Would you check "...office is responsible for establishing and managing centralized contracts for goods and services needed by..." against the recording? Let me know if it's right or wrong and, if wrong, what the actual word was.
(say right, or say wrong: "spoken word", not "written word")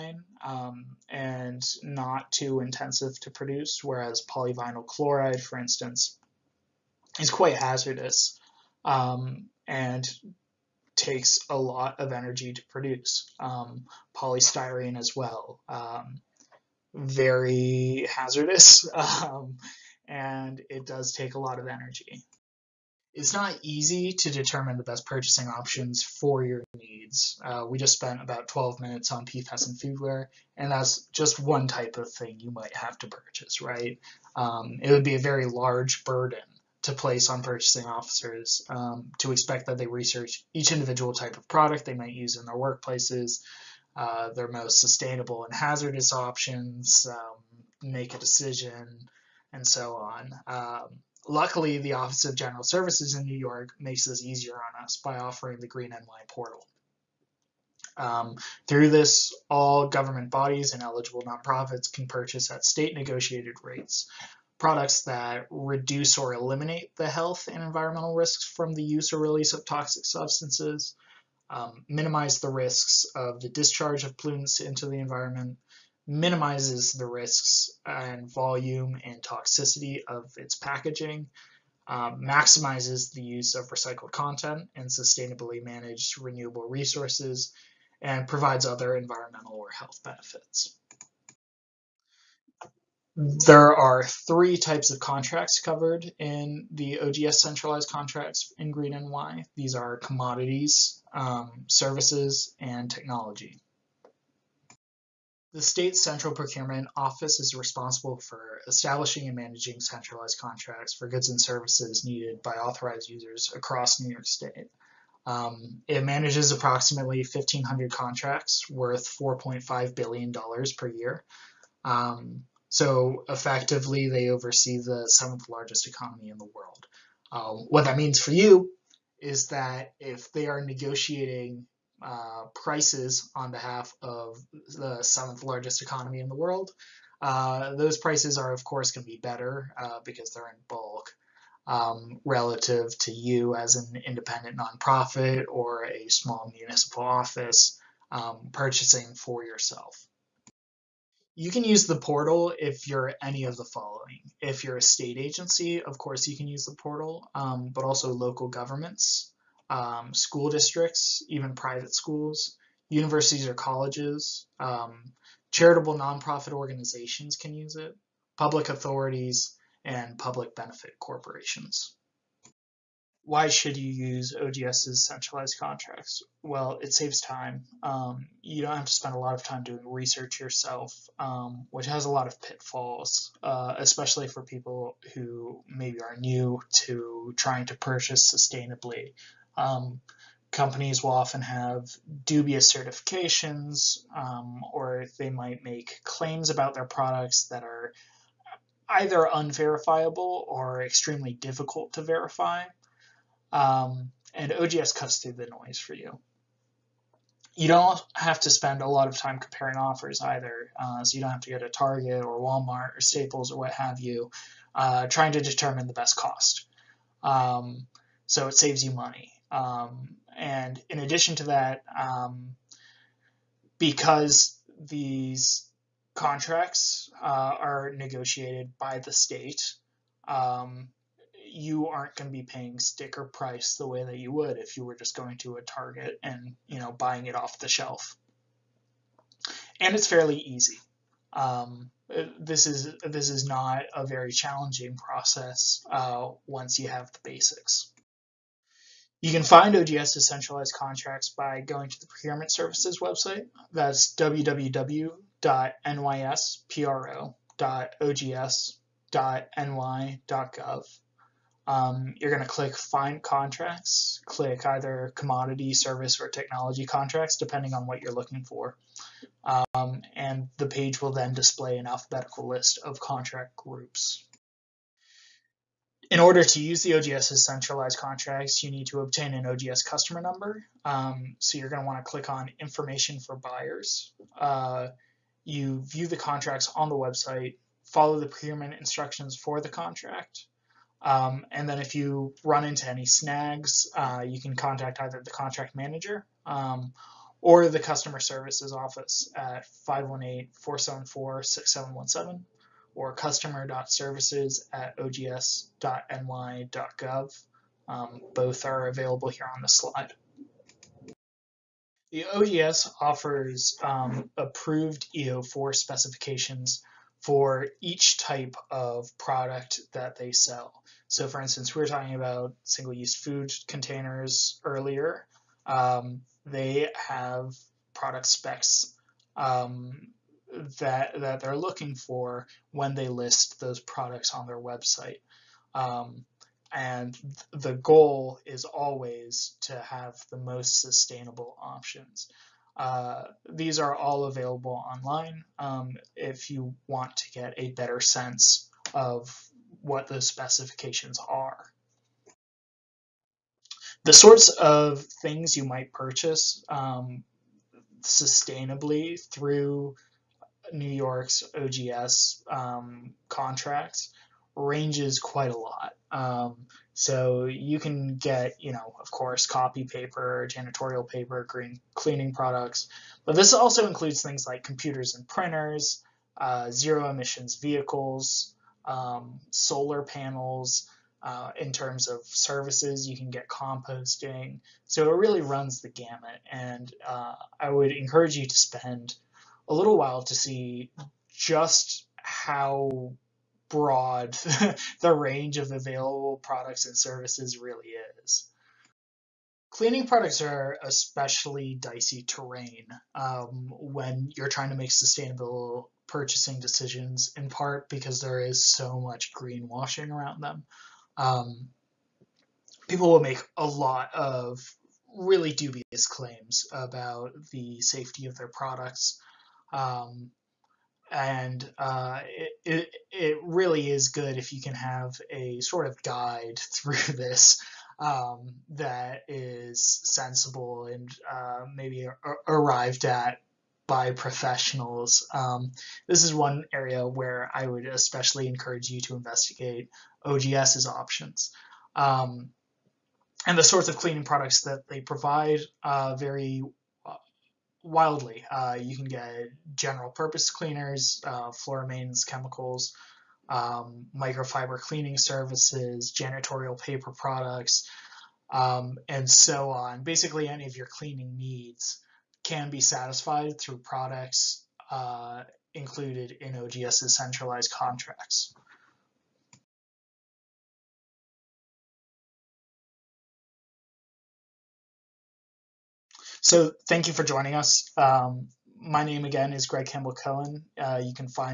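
right.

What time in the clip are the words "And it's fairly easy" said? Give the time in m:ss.
3:59.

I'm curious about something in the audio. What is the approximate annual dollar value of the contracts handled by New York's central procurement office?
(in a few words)
$4.5 billion.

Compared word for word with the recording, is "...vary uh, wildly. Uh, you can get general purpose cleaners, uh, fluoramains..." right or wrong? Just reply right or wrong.
right.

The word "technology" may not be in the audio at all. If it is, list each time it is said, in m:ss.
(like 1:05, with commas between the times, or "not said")
1:42, 4:26.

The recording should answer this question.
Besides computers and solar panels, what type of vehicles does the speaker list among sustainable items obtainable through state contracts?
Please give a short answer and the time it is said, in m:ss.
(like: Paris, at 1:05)
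zero emissions vehicles, at 6:16.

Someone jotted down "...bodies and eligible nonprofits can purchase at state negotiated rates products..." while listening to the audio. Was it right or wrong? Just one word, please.
right.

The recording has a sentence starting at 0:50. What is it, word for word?
Um, luckily, the Office of General Services in New York makes this easier on us by offering the Green NY portal.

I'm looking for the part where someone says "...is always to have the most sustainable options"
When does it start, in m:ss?
5:38.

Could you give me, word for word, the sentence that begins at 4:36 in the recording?
In order to use the OGS's centralized contracts, you need to obtain an OGS customer number.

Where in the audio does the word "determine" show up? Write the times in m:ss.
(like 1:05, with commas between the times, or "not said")
0:24, 3:35.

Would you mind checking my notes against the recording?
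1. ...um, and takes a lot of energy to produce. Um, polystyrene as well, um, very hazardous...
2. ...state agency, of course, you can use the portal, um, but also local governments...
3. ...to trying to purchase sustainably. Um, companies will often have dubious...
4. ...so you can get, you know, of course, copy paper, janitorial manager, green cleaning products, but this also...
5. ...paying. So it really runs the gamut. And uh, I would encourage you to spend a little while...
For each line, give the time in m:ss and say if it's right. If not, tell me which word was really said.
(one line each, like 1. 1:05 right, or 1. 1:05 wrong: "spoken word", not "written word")
1. 0:08 right
2. 2:34 right
3. 3:06 right
4. 6:06 wrong: "paper", not "manager"
5. 6:23 wrong: "composting", not "paying".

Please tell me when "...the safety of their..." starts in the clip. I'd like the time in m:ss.
6:57.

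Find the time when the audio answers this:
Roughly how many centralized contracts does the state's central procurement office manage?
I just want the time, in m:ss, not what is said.
1:57.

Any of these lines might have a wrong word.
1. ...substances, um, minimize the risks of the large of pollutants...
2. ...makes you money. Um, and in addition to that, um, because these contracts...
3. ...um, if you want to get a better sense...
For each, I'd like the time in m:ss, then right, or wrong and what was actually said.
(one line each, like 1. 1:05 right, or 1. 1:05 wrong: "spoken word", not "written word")
1. 1:10 wrong: "discharge", not "large"
2. 3:38 wrong: "saves", not "makes"
3. 5:45 right.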